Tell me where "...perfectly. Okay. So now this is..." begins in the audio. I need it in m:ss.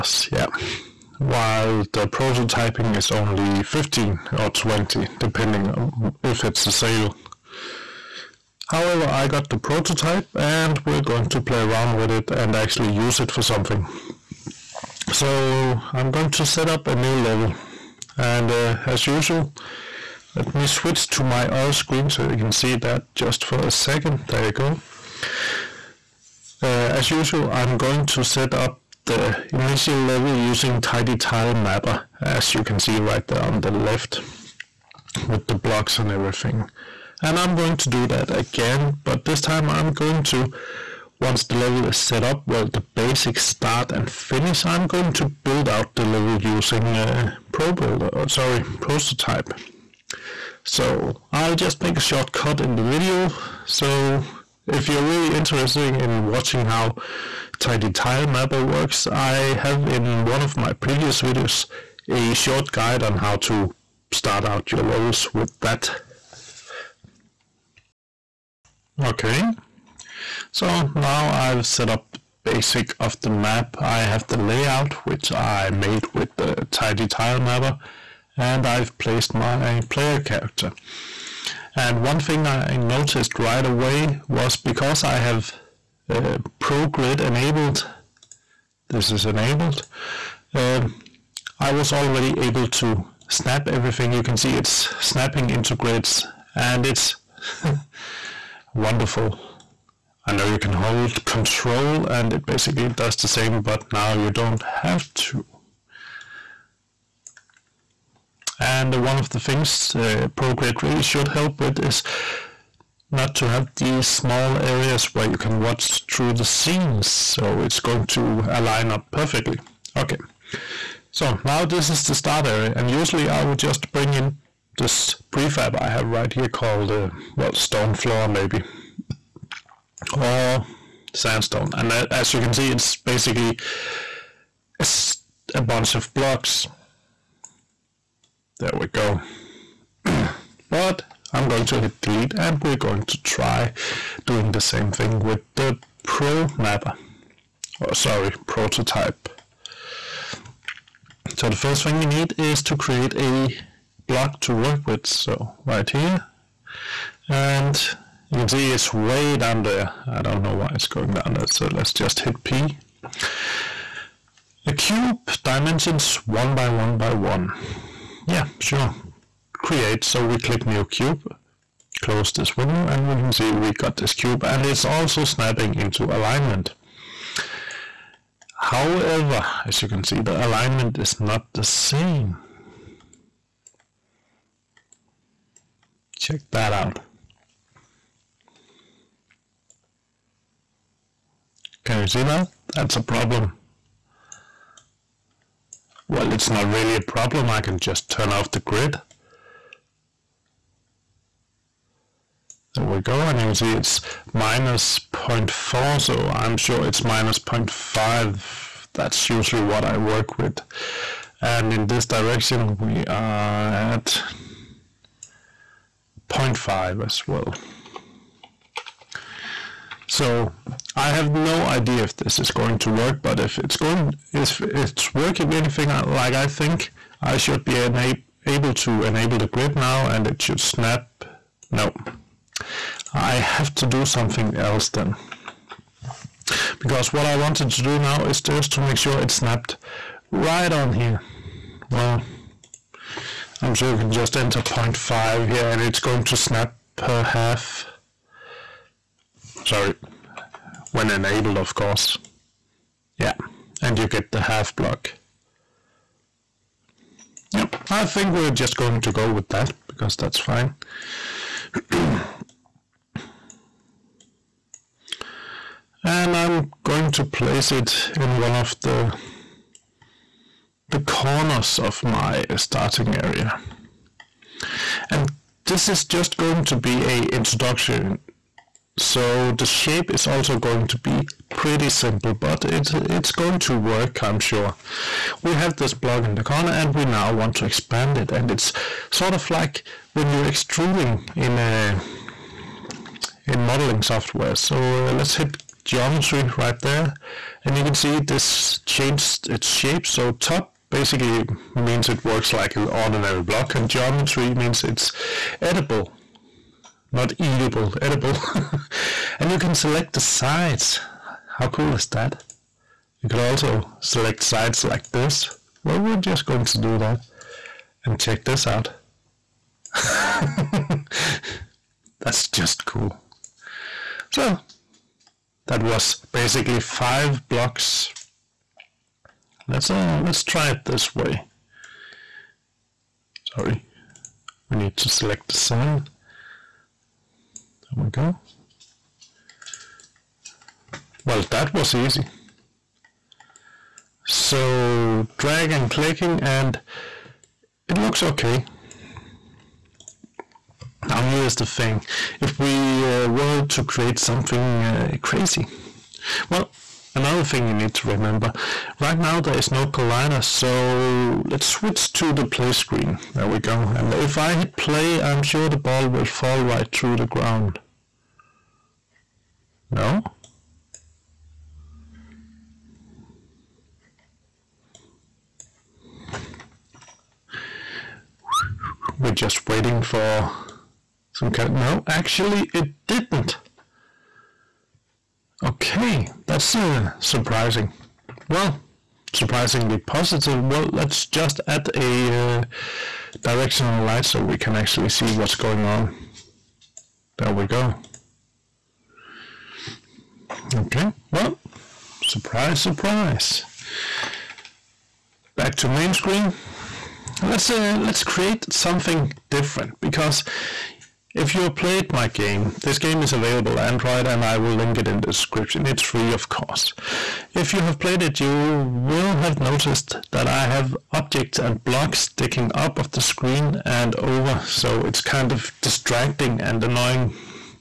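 1:59.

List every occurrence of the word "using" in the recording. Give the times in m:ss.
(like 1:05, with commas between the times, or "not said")
0:30, 0:46.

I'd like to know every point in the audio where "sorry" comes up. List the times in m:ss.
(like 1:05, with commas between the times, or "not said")
0:48, 2:27, 4:09, 5:33.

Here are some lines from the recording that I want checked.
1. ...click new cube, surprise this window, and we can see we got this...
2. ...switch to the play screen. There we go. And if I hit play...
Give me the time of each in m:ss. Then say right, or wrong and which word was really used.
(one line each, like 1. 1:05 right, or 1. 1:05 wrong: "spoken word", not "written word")
1. 2:50 wrong: "close", not "surprise"
2. 6:01 right.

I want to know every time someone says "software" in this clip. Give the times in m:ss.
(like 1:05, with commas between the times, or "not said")
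4:54.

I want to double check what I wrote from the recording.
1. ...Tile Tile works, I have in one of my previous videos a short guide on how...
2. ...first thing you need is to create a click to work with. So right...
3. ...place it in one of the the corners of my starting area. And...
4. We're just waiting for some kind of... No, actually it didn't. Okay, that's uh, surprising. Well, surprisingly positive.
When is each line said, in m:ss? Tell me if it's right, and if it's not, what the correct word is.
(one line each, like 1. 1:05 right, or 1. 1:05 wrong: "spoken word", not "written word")
1. 0:57 wrong: "Mapper", not "Tile"
2. 2:31 wrong: "block", not "click"
3. 4:27 right
4. 6:19 right.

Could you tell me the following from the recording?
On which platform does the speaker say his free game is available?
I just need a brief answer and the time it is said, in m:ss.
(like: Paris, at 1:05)
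Android, at 6:53.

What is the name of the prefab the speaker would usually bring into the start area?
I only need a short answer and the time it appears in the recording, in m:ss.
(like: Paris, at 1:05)
stone floor, at 2:07.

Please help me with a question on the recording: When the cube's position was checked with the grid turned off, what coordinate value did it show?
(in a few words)
-0.4.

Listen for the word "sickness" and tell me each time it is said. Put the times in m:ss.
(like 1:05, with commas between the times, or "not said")
not said.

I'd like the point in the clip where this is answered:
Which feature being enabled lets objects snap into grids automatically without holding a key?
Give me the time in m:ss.
1:26.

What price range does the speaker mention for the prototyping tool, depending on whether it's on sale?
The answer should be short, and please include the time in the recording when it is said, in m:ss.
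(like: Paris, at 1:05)
15 or 20, at 0:03.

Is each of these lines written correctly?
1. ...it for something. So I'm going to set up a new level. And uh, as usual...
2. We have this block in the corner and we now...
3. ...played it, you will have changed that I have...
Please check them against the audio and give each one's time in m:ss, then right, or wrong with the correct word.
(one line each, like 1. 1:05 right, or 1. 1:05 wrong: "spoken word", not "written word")
1. 0:13 right
2. 4:45 right
3. 6:57 wrong: "noticed", not "changed".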